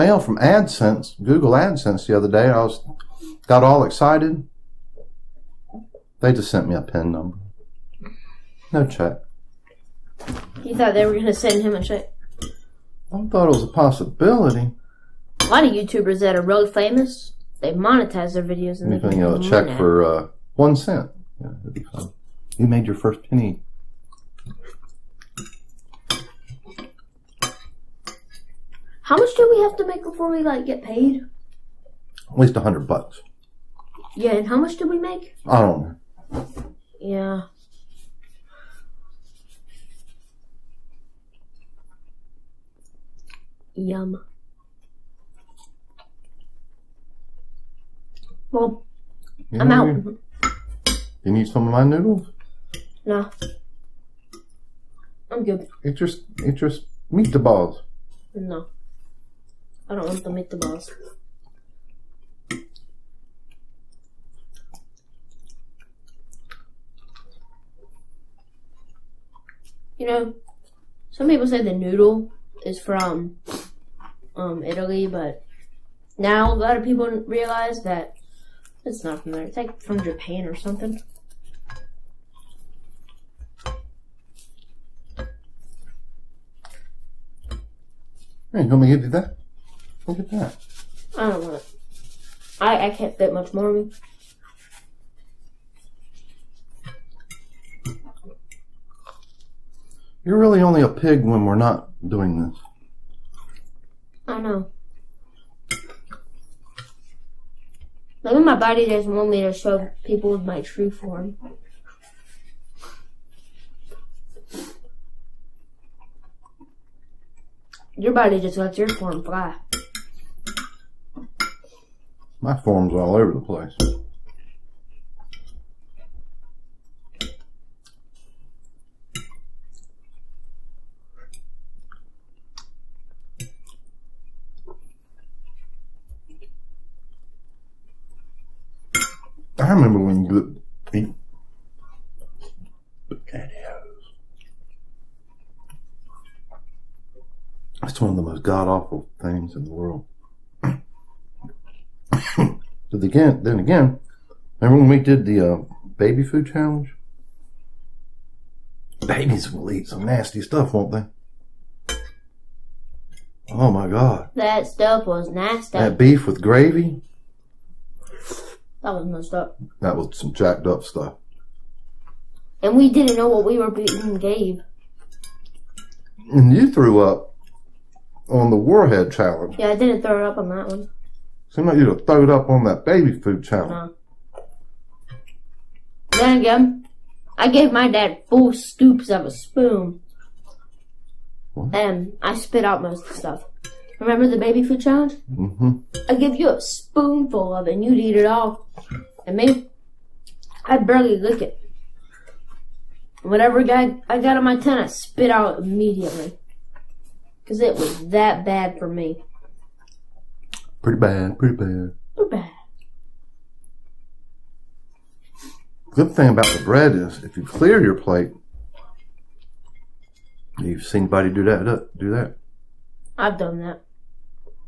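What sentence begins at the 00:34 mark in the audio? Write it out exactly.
Yeah, and how much did we make?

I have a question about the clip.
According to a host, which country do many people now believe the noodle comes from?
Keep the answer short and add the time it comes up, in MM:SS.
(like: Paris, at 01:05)
Japan, at 01:20.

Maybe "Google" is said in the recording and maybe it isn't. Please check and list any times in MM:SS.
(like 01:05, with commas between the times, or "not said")
00:01.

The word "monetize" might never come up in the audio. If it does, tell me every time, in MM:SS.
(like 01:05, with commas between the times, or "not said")
00:17.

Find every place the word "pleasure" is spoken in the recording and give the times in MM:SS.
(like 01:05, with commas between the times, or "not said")
not said.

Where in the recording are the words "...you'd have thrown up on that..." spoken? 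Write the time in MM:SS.
03:01.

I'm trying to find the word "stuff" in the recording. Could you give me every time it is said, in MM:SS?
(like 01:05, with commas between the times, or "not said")
02:40, 02:44, 02:50, 03:13.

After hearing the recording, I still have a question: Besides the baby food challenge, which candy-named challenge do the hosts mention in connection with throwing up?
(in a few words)
Warhead Challenge.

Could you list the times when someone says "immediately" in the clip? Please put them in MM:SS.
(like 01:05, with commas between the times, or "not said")
03:25.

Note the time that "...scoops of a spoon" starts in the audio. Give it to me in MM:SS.
03:08.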